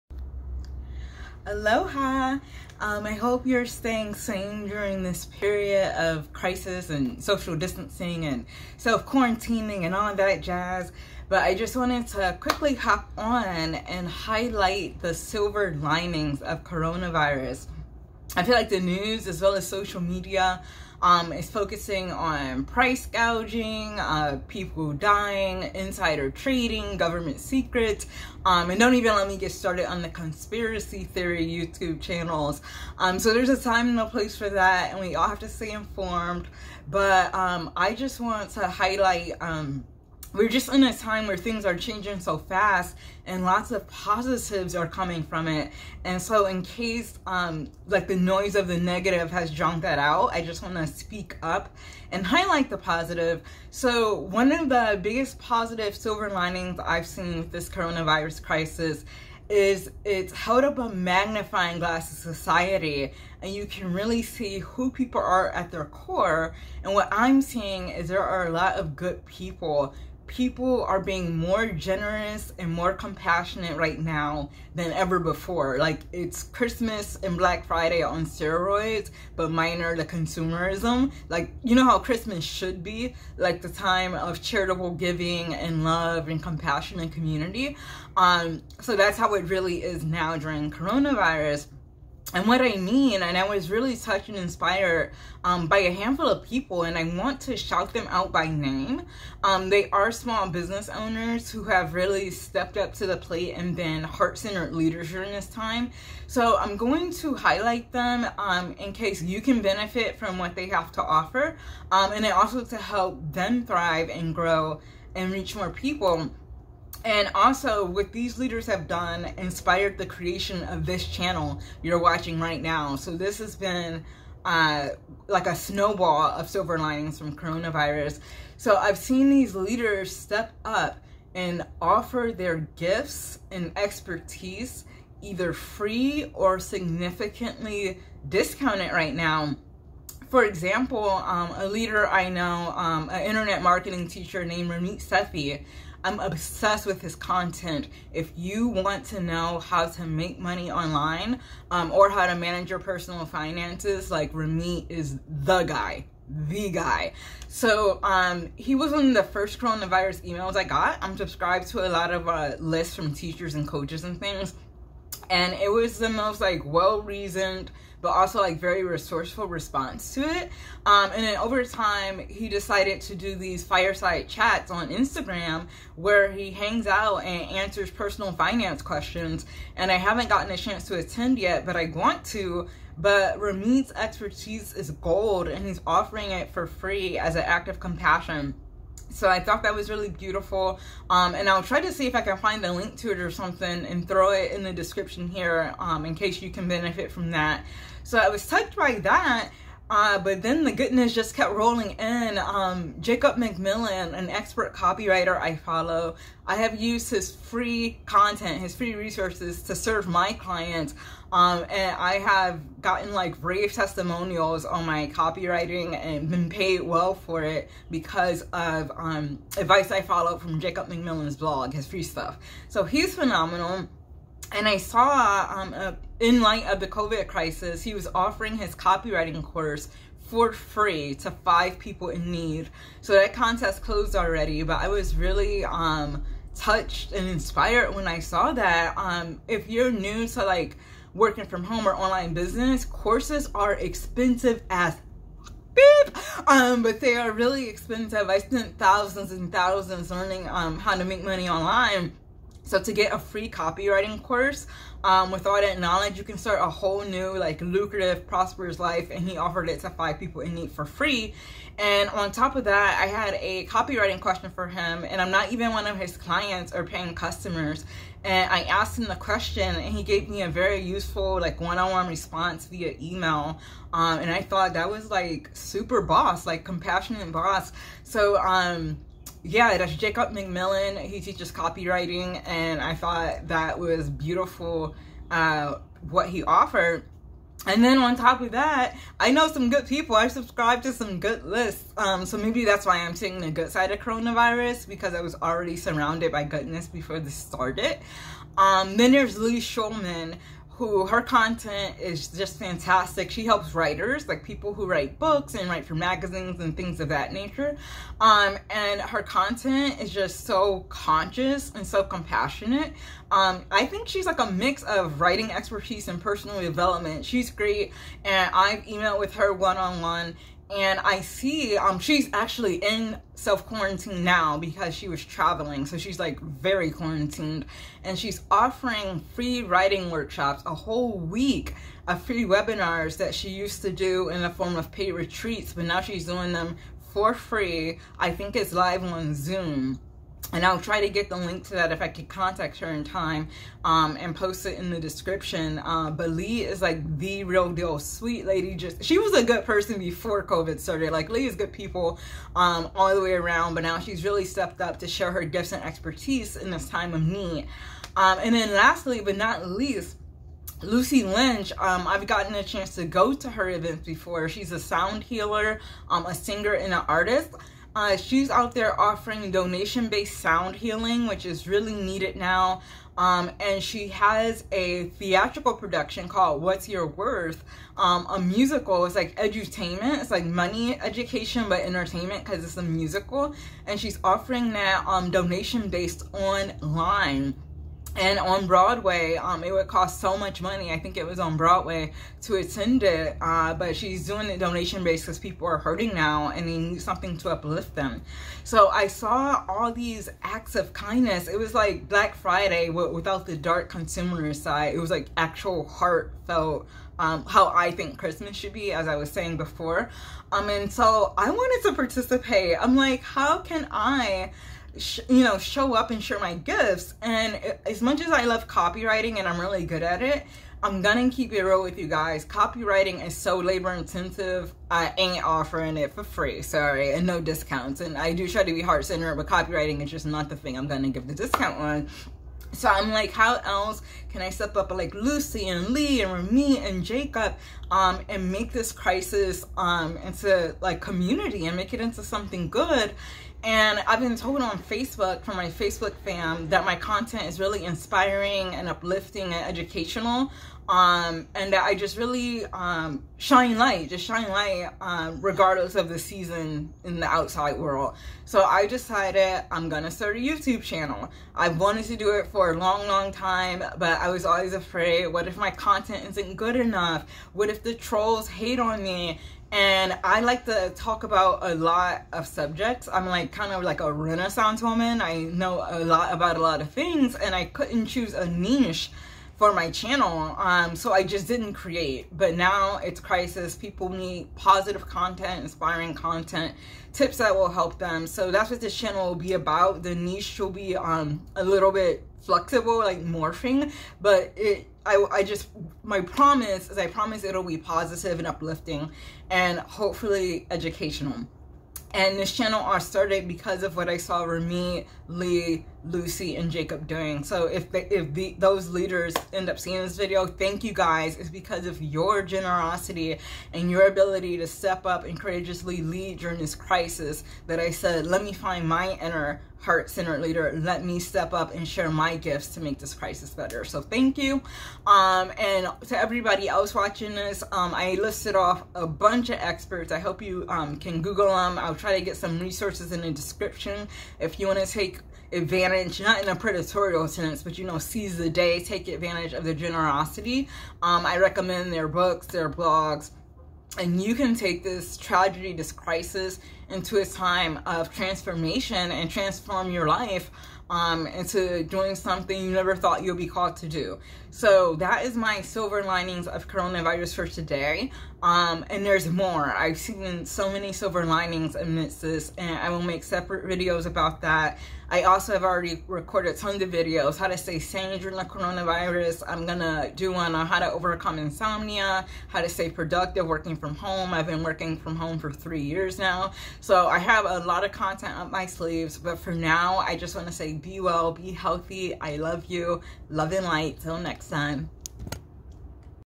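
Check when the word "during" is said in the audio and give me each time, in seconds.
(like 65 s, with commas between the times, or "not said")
4 s, 90 s, 105 s, 516 s, 568 s.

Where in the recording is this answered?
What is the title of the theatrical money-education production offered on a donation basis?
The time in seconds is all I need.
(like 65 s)
376 s.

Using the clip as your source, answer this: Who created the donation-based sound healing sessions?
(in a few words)
Lucie Lynch.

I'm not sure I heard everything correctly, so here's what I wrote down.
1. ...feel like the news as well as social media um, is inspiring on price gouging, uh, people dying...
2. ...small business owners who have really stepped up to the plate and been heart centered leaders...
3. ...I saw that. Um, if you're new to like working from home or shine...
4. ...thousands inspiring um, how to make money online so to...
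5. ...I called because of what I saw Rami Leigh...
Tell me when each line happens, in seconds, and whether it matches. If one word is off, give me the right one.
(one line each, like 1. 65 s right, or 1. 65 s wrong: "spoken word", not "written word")
1. 18 s wrong: "focusing", not "inspiring"
2. 100 s right
3. 238 s wrong: "online", not "shine"
4. 249 s wrong: "learning", not "inspiring"
5. 502 s wrong: "started", not "called".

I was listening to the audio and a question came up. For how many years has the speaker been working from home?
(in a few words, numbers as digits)
3.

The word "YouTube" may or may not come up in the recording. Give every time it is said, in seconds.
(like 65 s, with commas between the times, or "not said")
31 s, 460 s.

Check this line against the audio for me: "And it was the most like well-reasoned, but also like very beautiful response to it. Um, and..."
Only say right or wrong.
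wrong.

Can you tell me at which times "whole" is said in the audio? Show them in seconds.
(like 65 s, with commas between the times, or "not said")
256 s, 330 s.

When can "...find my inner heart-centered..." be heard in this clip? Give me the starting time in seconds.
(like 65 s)
518 s.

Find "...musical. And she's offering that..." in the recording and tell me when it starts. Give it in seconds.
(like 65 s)
382 s.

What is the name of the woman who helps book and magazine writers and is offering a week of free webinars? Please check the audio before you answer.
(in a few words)
Leigh Schulman.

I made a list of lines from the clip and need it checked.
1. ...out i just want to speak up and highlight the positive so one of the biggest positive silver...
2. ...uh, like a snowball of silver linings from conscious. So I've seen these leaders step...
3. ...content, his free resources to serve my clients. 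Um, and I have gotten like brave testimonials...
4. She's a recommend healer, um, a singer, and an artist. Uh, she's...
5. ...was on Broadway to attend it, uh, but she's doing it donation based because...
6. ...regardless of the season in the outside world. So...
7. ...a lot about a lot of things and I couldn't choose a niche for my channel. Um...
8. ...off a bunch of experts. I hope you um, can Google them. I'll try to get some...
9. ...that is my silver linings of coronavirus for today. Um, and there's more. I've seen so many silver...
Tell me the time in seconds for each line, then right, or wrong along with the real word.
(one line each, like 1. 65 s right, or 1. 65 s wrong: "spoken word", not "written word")
1. 49 s right
2. 124 s wrong: "coronavirus", not "conscious"
3. 208 s right
4. 364 s wrong: "sound", not "recommend"
5. 391 s right
6. 455 s right
7. 475 s right
8. 528 s right
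9. 554 s right.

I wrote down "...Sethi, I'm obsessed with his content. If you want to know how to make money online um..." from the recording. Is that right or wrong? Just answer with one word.
right.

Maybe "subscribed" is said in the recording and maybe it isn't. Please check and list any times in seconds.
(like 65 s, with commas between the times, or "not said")
161 s, 290 s.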